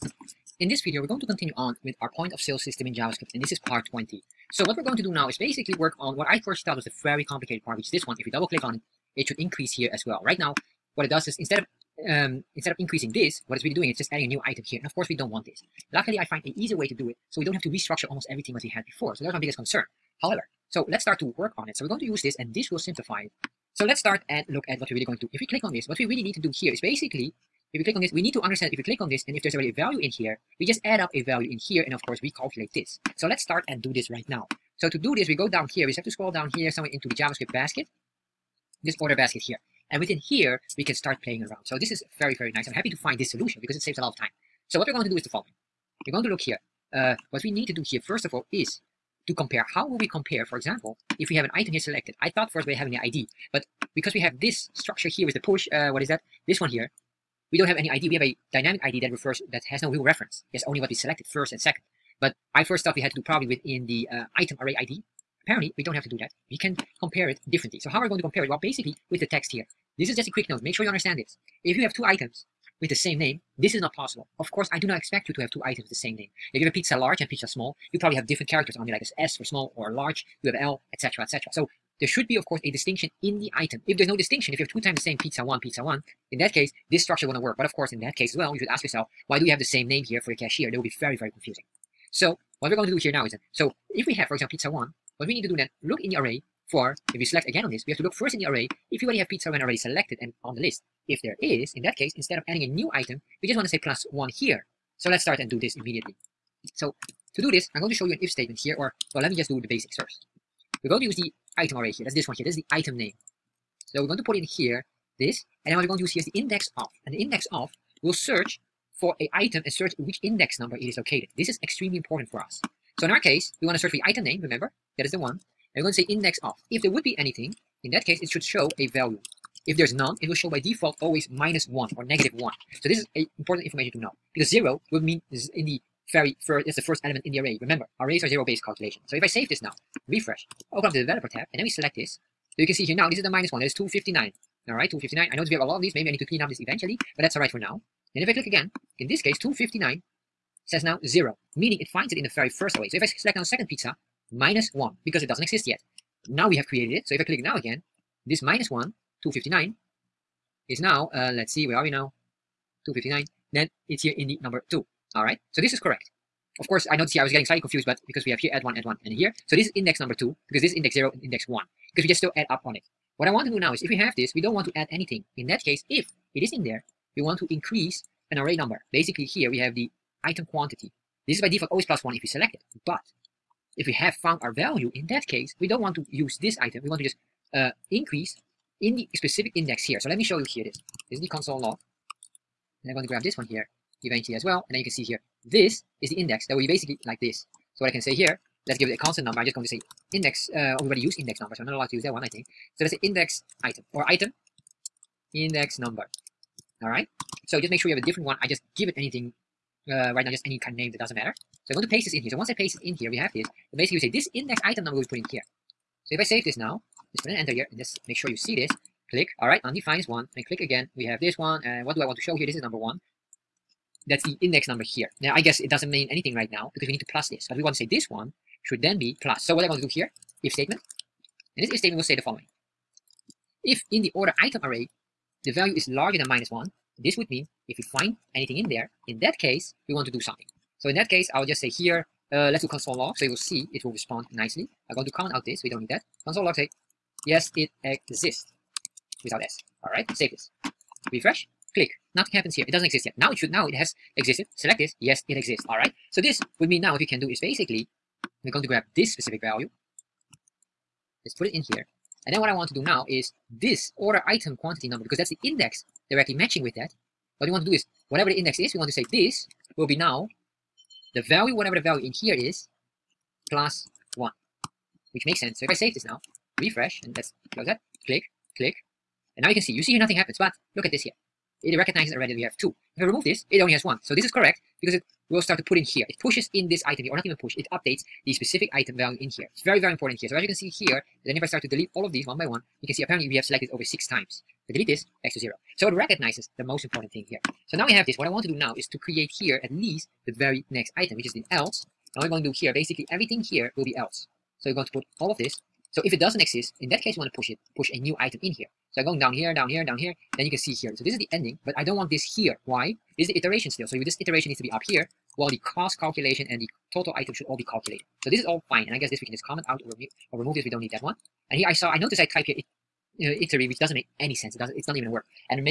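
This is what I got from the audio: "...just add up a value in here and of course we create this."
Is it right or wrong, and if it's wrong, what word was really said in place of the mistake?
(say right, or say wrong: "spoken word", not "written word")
wrong: "calculate", not "create".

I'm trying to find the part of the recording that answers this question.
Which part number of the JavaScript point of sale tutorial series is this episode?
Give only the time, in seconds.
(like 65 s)
3 s.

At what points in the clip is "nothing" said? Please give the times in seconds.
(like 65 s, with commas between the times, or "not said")
252 s, 279 s.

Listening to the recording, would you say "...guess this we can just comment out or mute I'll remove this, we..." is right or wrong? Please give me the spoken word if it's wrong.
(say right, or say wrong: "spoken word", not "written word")
right.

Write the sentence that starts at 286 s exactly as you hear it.
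It pushes in this item here, or not even push, it updates the specific item value in here.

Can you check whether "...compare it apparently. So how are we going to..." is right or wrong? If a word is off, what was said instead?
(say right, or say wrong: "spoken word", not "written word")
wrong: "differently", not "apparently".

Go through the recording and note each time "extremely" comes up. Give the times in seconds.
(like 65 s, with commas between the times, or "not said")
121 s.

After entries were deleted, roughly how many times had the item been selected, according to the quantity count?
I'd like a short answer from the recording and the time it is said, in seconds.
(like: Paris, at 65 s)
6, at 293 s.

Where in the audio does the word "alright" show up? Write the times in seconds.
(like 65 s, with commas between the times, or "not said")
219 s, 249 s, 255 s.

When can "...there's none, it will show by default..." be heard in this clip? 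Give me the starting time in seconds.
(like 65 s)
129 s.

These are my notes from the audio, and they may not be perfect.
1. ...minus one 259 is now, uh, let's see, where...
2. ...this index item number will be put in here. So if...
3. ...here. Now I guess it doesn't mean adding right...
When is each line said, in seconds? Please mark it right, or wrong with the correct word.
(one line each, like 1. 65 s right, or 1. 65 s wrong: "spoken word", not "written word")
1. 158 s right
2. 214 s right
3. 224 s wrong: "anything", not "adding".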